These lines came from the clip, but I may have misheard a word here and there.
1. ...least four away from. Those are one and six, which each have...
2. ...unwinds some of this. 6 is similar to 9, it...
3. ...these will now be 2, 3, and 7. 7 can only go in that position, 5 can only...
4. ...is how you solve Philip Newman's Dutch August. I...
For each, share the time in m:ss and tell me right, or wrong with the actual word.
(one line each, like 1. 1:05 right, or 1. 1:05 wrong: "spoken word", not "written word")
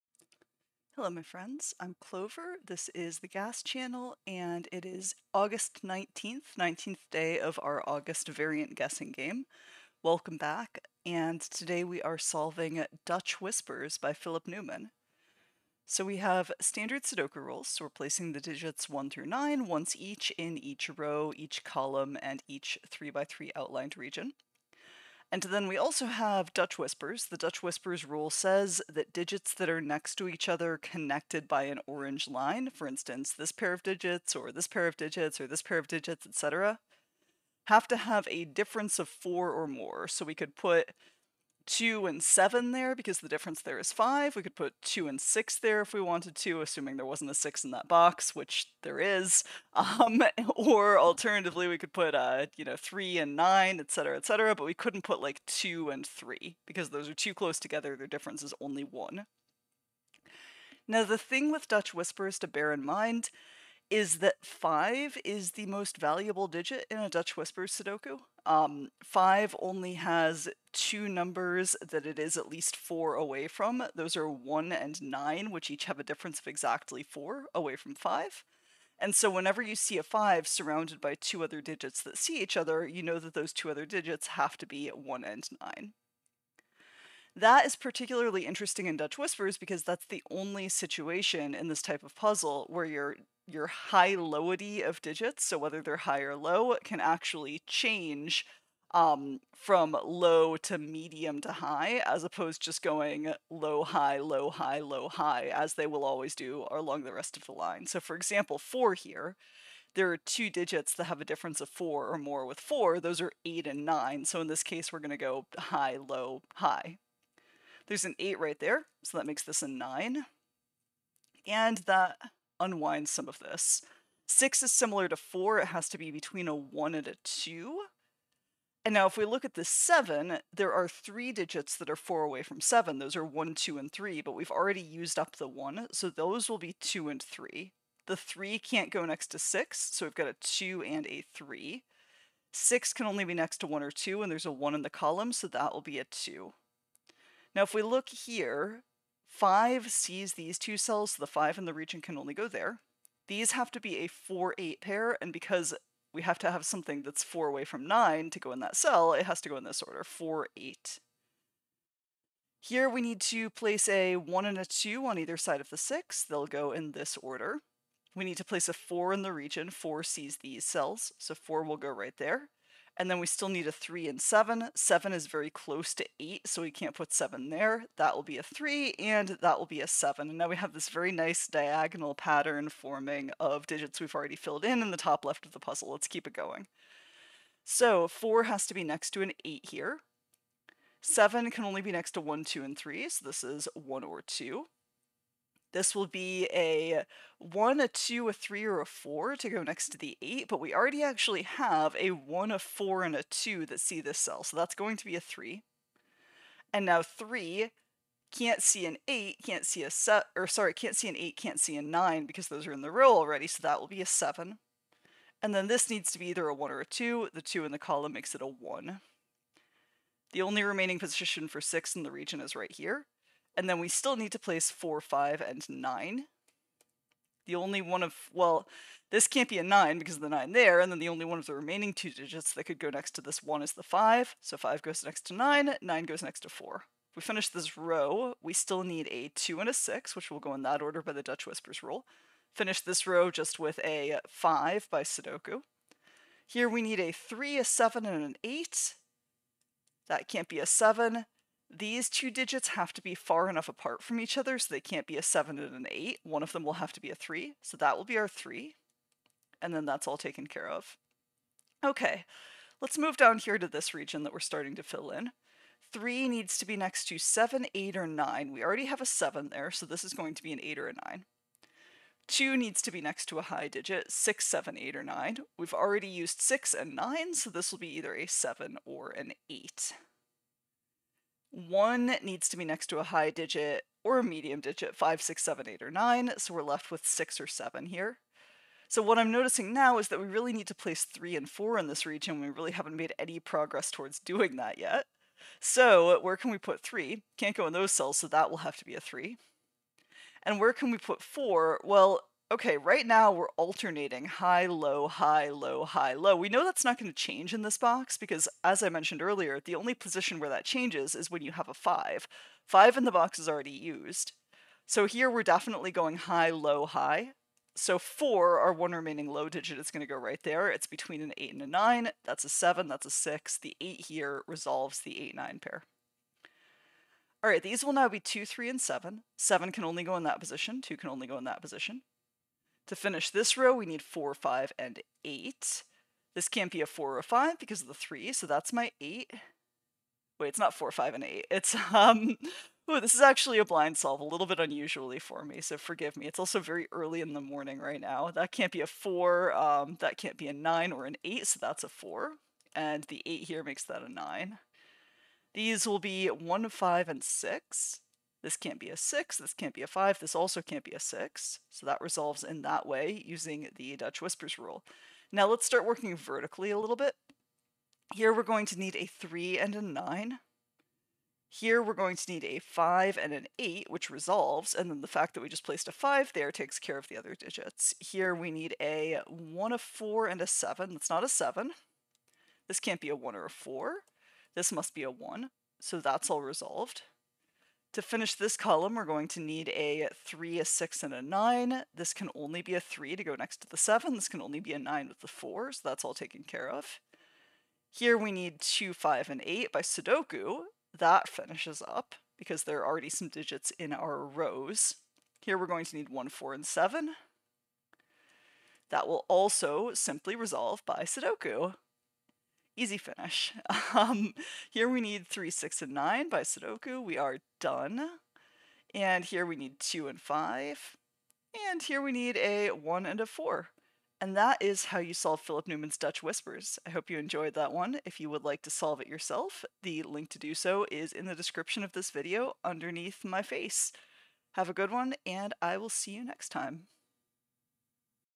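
1. 1:12 wrong: "nine", not "six"
2. 2:02 wrong: "4", not "9"
3. 5:27 wrong: "2", not "5"
4. 7:04 wrong: "Whispers", not "August".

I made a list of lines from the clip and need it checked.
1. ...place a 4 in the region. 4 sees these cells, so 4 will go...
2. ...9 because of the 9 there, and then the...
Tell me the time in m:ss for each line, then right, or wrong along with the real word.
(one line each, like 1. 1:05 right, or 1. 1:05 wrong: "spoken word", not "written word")
1. 2:48 right
2. 3:49 right.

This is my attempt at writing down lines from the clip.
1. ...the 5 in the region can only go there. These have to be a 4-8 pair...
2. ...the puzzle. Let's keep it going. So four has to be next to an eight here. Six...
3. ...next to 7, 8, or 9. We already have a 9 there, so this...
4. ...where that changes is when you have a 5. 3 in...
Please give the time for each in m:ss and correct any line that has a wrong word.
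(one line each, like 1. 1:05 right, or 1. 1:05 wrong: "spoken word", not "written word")
1. 2:31 right
2. 3:05 wrong: "Seven", not "Six"
3. 4:26 wrong: "7", not "9"
4. 5:10 wrong: "5", not "3".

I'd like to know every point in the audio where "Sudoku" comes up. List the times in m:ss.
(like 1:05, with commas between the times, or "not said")
0:17, 1:07, 4:05, 6:39, 6:51, 6:56.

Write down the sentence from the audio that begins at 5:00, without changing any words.
And where can we put four?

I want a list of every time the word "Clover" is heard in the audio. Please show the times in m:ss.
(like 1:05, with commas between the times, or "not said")
0:01.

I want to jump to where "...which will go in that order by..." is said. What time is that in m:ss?
4:00.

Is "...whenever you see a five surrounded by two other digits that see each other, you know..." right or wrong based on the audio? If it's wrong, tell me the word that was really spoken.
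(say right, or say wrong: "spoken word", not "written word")
right.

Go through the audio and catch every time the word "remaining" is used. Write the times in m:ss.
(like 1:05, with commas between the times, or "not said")
3:40, 3:51, 5:18.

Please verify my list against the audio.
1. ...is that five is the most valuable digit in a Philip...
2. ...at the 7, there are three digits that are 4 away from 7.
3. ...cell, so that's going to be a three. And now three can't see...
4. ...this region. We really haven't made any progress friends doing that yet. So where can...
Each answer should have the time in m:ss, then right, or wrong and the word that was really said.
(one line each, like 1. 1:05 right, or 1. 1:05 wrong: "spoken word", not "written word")
1. 1:03 wrong: "Dutch", not "Philip"
2. 2:09 right
3. 3:24 right
4. 4:51 wrong: "towards", not "friends".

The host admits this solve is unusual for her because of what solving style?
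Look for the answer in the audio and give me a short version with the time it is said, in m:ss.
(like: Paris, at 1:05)
blind solve, at 5:43.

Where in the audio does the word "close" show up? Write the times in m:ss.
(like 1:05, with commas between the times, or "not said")
0:57, 2:55.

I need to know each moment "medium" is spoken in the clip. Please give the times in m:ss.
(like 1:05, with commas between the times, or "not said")
1:40, 4:44.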